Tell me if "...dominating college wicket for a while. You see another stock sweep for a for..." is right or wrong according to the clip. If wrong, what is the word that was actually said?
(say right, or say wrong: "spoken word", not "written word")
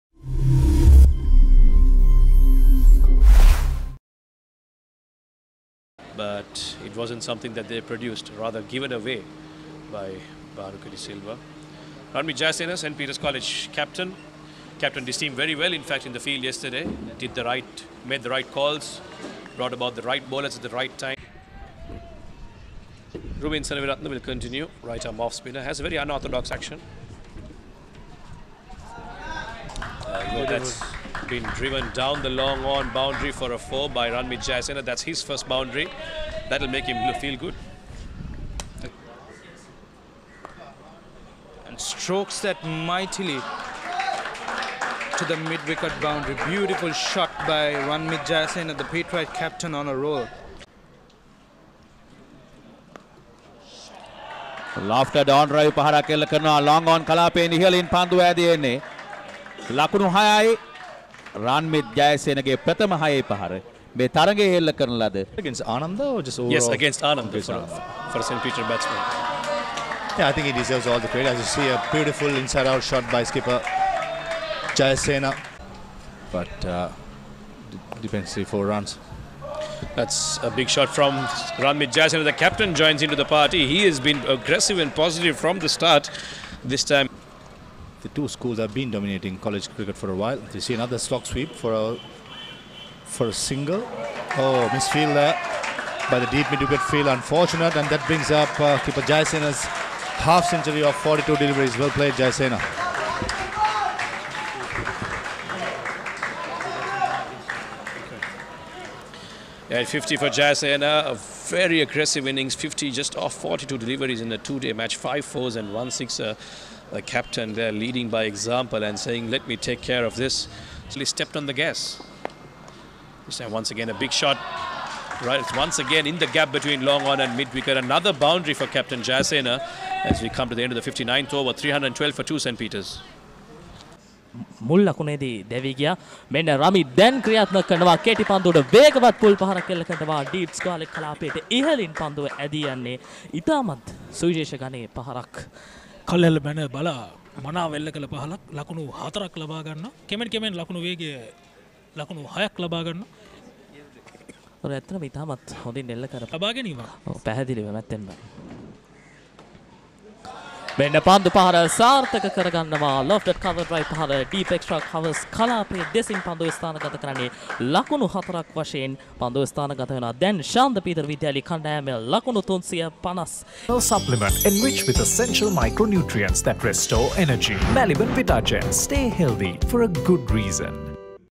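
wrong: "cricket", not "wicket".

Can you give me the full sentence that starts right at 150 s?
කෙමෙන් කෙමෙන් ලකුණු වේගය ලකුණු හයක් ලබා ගන්නවා.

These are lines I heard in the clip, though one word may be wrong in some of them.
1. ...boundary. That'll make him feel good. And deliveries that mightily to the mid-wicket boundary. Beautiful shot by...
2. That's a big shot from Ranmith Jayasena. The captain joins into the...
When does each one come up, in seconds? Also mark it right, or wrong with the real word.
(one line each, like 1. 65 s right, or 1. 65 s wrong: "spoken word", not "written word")
1. 35 s wrong: "strokes", not "deliveries"
2. 79 s right.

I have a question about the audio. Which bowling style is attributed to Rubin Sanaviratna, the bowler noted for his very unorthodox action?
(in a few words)
Right arm off spinner.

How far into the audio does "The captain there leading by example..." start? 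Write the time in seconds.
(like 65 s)
116 s.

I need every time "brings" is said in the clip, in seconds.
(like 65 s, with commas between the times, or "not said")
98 s.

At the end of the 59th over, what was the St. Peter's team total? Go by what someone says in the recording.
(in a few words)
312 for 2.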